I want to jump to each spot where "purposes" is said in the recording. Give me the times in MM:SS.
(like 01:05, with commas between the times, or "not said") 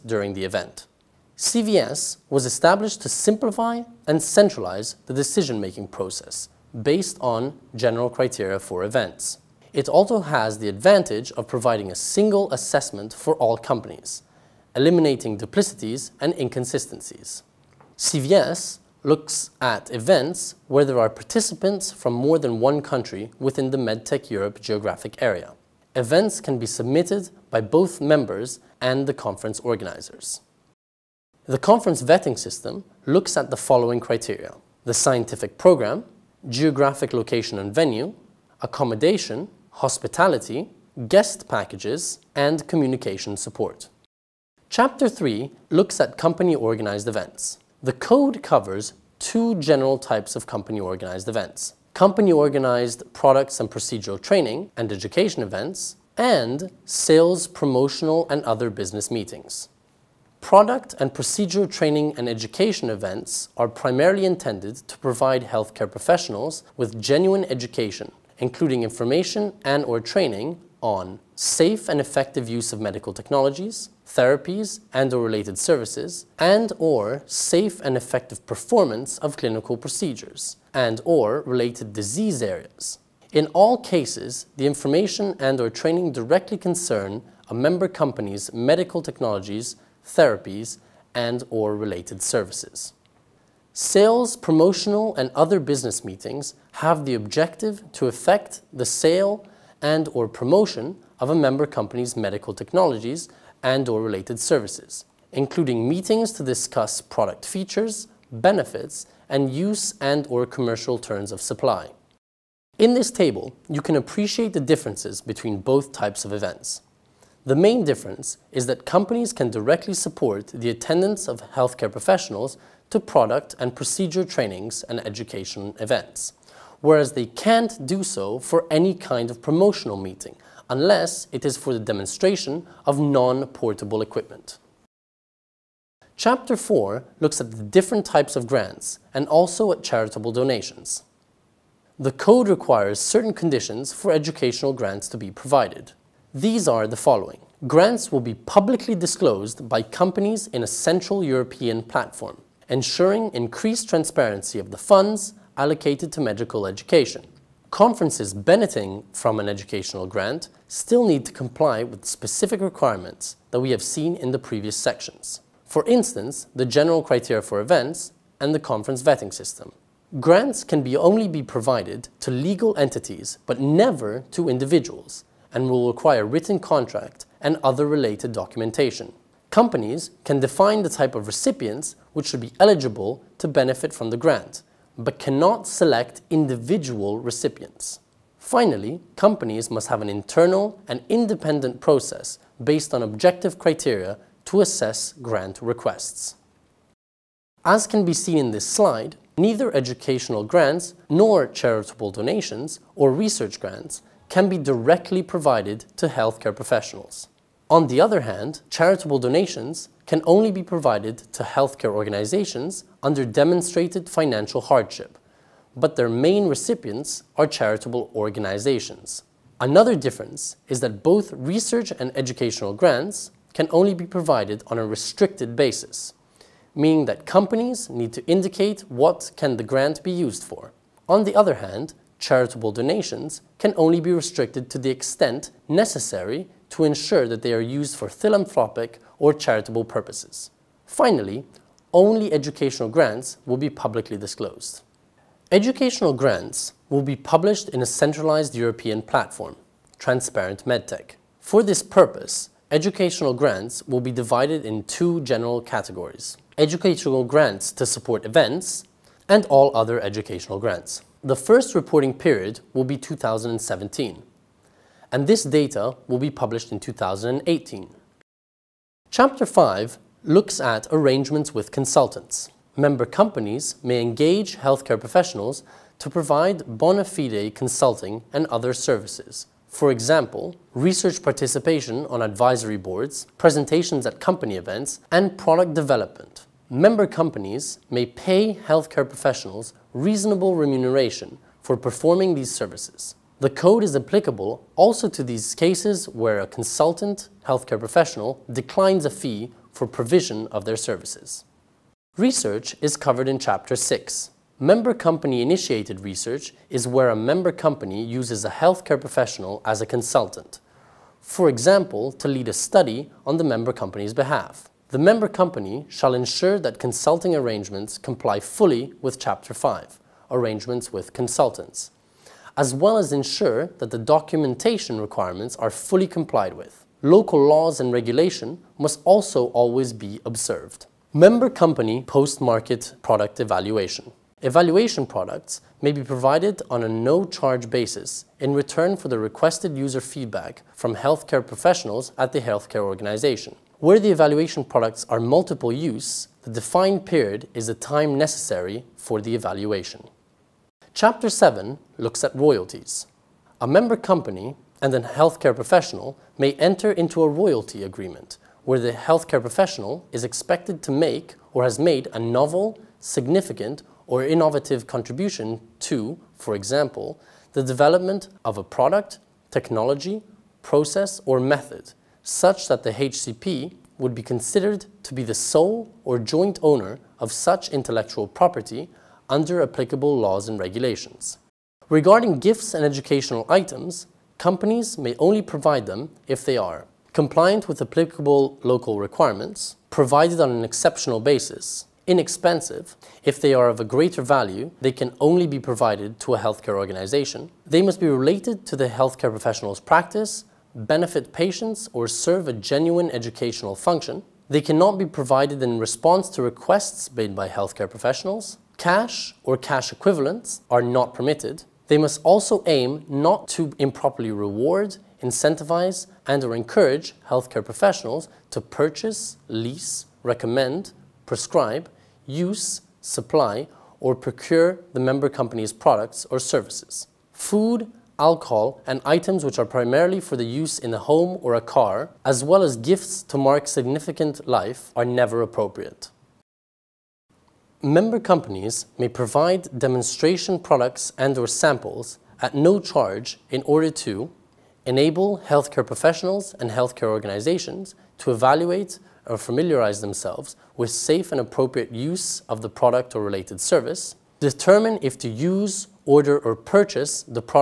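03:59, 04:11.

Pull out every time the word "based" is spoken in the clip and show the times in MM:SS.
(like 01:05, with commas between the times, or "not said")
00:06, 03:12.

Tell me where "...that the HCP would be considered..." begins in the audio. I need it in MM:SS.
06:12.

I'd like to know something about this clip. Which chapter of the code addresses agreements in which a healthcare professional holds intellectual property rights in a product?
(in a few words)
Chapter 7.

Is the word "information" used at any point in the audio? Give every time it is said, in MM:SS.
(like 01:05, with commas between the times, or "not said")
01:08, 01:24.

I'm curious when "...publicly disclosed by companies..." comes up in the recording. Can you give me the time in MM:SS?
02:28.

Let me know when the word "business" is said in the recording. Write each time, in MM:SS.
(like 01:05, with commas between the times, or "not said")
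00:58, 01:35.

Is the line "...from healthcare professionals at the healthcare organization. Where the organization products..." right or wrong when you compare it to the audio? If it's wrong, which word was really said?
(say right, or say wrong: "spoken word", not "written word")
wrong: "evaluation", not "organization".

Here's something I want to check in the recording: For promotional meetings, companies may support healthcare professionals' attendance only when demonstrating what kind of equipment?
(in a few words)
Non-portable equipment.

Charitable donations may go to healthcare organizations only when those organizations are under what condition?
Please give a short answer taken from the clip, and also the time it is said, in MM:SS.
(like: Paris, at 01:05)
Demonstrated financial hardship, at 03:33.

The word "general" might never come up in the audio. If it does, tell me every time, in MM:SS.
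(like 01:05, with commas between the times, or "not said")
00:07, 00:49, 02:46, 04:15.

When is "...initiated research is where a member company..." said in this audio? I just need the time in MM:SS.
05:05.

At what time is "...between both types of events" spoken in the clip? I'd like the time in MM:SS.
01:55.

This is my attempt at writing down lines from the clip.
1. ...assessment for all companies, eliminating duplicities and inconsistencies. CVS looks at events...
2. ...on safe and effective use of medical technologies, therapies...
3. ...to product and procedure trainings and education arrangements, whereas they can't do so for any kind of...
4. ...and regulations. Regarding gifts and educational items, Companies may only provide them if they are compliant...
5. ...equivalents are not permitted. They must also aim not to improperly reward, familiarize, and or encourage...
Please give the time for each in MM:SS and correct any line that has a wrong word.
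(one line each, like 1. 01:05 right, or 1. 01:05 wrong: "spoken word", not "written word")
1. 00:12 right
2. 01:10 right
3. 02:02 wrong: "events", not "arrangements"
4. 06:20 right
5. 06:49 wrong: "incentivize", not "familiarize".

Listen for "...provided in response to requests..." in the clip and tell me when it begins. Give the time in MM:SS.
06:45.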